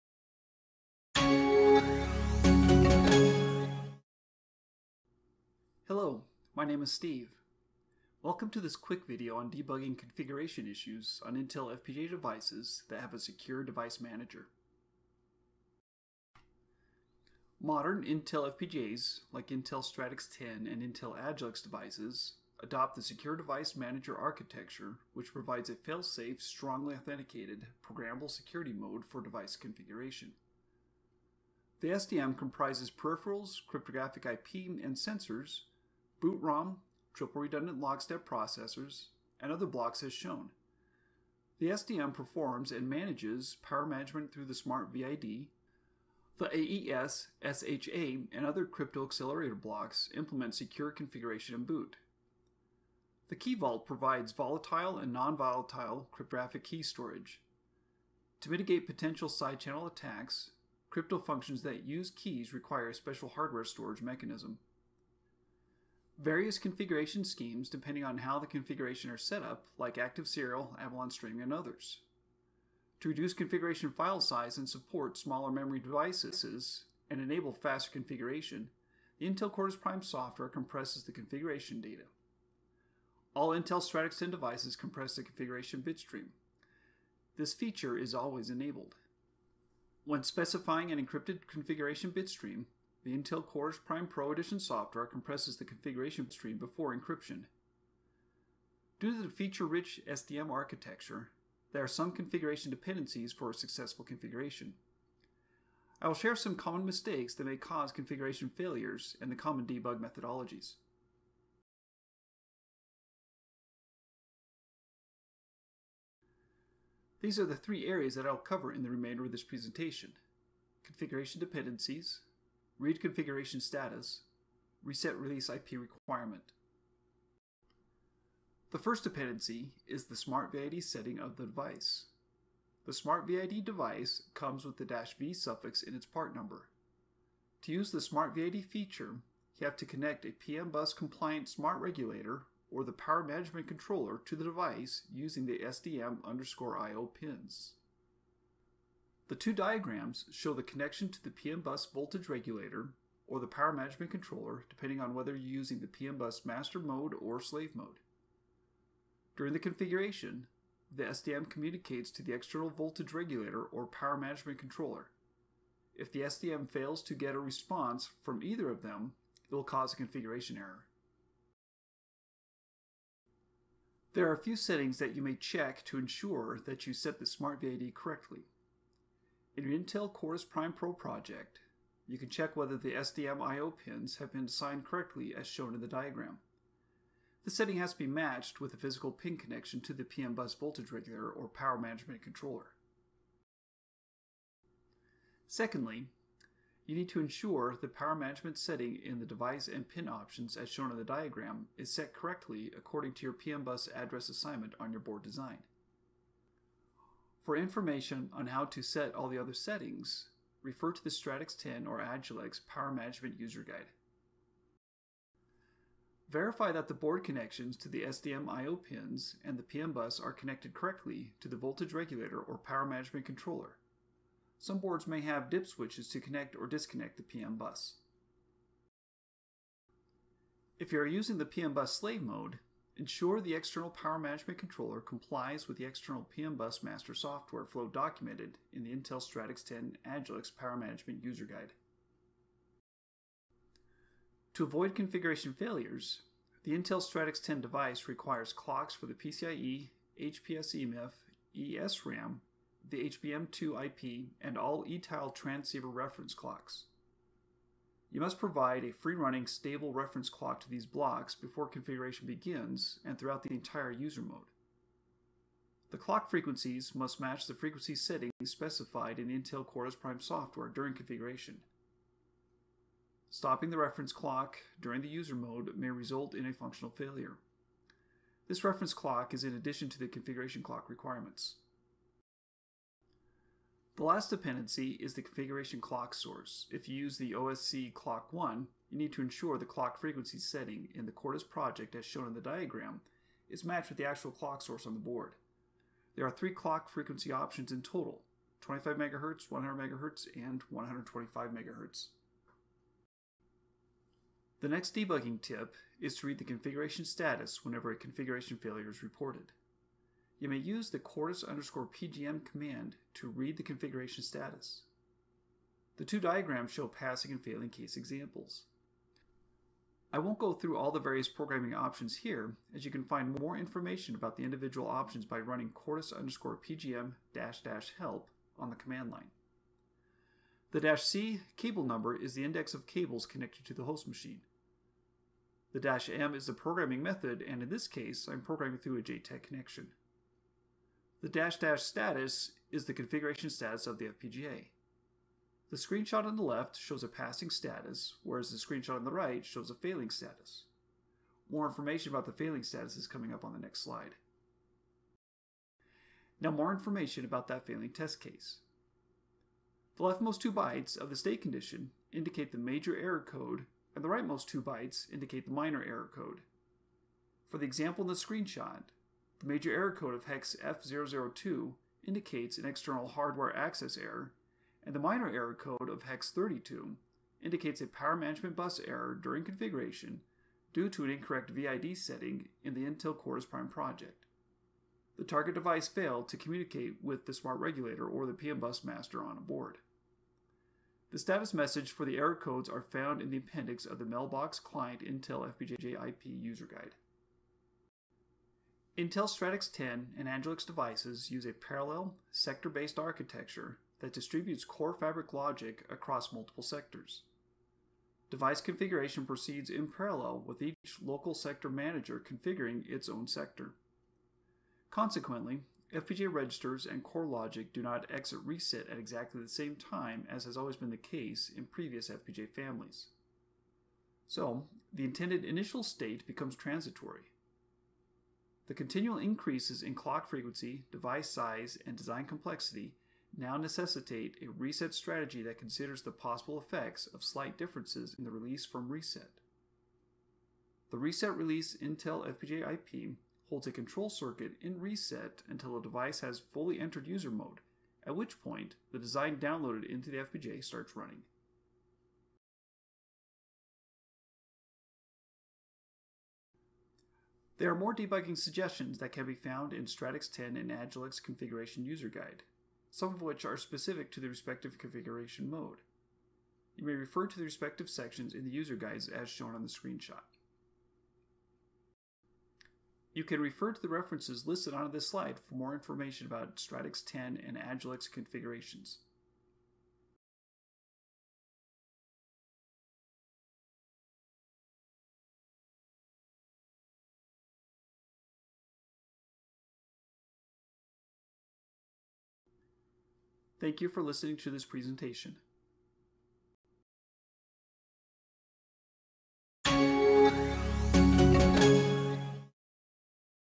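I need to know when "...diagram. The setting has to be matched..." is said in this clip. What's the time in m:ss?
3:05.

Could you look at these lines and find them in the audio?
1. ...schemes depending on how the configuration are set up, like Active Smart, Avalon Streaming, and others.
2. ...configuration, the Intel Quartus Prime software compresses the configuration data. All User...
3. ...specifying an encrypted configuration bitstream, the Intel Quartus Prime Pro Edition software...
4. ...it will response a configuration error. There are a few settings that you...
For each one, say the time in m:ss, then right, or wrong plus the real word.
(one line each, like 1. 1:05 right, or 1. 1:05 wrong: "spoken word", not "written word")
1. 1:07 wrong: "Serial", not "Smart"
2. 1:17 wrong: "Intel", not "User"
3. 1:30 right
4. 2:49 wrong: "cause", not "response".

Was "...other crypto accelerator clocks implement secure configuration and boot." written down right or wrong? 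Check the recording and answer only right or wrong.
wrong.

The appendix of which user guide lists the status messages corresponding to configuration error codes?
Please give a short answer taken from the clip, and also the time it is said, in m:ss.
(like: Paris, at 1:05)
Mailbox Client Intel FPGA IP user guide, at 6:34.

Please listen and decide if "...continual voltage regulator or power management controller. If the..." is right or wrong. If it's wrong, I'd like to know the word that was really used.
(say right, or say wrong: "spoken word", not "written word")
wrong: "external", not "continual".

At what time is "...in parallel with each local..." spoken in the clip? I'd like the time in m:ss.
6:49.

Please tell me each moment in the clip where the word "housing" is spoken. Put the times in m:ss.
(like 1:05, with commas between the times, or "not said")
not said.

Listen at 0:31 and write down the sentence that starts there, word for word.
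The SDM comprises peripherals, cryptographic IP, and sensors boot ROM, triple redundant lockstep processors, and other blocks as shown.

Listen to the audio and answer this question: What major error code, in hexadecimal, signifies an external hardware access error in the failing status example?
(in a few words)
0xF002.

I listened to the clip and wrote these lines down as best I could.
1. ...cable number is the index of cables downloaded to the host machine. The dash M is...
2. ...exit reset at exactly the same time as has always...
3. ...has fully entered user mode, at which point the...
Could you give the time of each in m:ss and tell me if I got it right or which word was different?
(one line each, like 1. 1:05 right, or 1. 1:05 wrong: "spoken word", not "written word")
1. 5:31 wrong: "connected", not "downloaded"
2. 6:58 right
3. 7:26 right.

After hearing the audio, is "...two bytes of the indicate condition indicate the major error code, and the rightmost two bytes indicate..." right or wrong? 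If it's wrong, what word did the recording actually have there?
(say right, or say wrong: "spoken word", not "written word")
wrong: "state", not "indicate".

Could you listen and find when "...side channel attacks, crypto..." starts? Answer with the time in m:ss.
0:59.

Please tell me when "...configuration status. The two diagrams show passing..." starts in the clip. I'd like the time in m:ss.
5:13.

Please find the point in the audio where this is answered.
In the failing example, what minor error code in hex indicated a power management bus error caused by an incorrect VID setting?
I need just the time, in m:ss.
6:16.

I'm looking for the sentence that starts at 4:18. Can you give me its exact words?
You must provide a free-running stable reference clock to these blocks before configuration begins and throughout the entire user mode.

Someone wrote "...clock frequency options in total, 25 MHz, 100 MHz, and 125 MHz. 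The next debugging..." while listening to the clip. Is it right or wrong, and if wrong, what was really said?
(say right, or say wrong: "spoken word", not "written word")
right.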